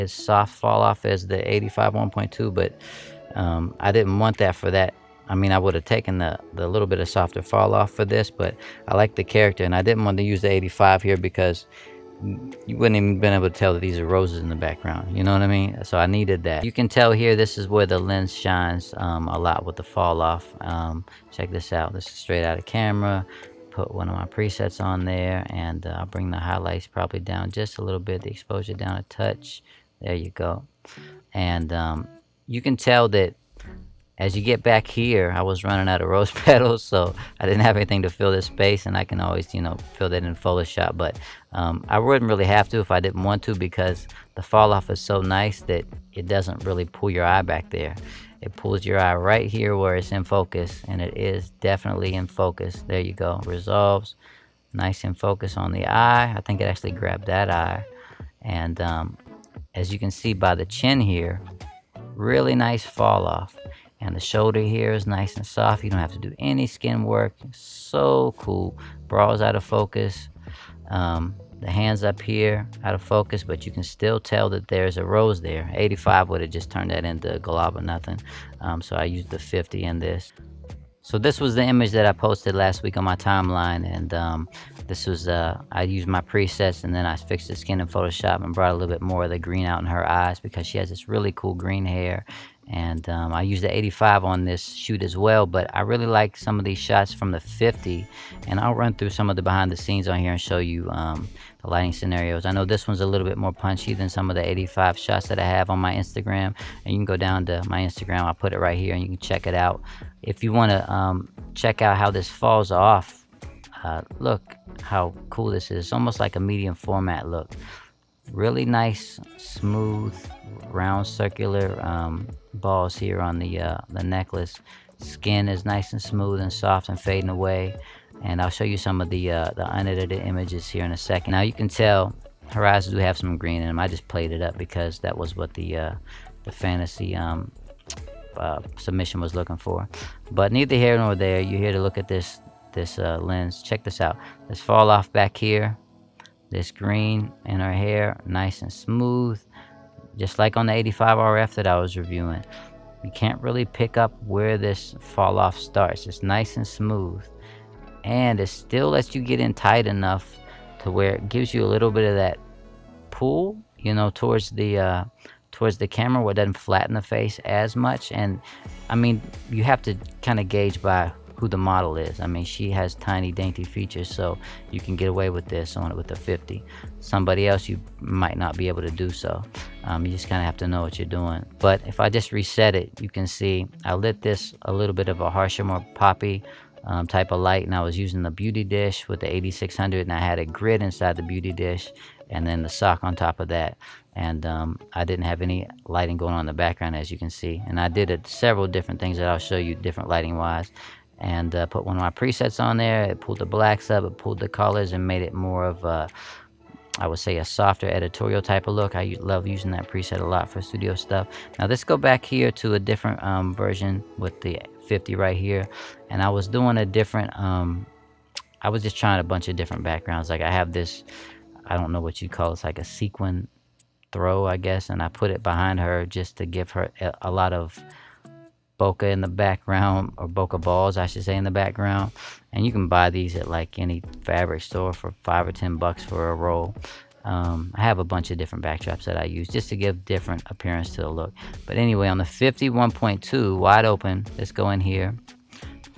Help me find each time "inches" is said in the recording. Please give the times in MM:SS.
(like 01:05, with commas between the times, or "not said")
not said.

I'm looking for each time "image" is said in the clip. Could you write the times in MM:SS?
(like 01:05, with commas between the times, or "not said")
01:21, 02:10.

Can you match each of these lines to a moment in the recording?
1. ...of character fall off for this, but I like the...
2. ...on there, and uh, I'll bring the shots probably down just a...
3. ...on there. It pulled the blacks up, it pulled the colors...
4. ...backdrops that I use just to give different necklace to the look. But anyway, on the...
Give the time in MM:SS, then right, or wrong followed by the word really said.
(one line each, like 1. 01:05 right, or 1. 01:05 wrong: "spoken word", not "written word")
1. 00:06 wrong: "softer", not "character"
2. 00:24 wrong: "highlights", not "shots"
3. 03:22 right
4. 03:58 wrong: "appearance", not "necklace".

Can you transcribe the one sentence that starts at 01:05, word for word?
You don't have to do any skin work.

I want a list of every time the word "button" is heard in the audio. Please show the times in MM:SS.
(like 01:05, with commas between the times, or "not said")
not said.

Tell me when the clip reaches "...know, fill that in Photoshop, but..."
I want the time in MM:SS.
00:39.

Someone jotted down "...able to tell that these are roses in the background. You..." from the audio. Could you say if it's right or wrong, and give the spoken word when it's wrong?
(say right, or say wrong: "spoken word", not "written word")
right.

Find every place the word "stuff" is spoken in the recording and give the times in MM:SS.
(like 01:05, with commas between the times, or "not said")
03:30.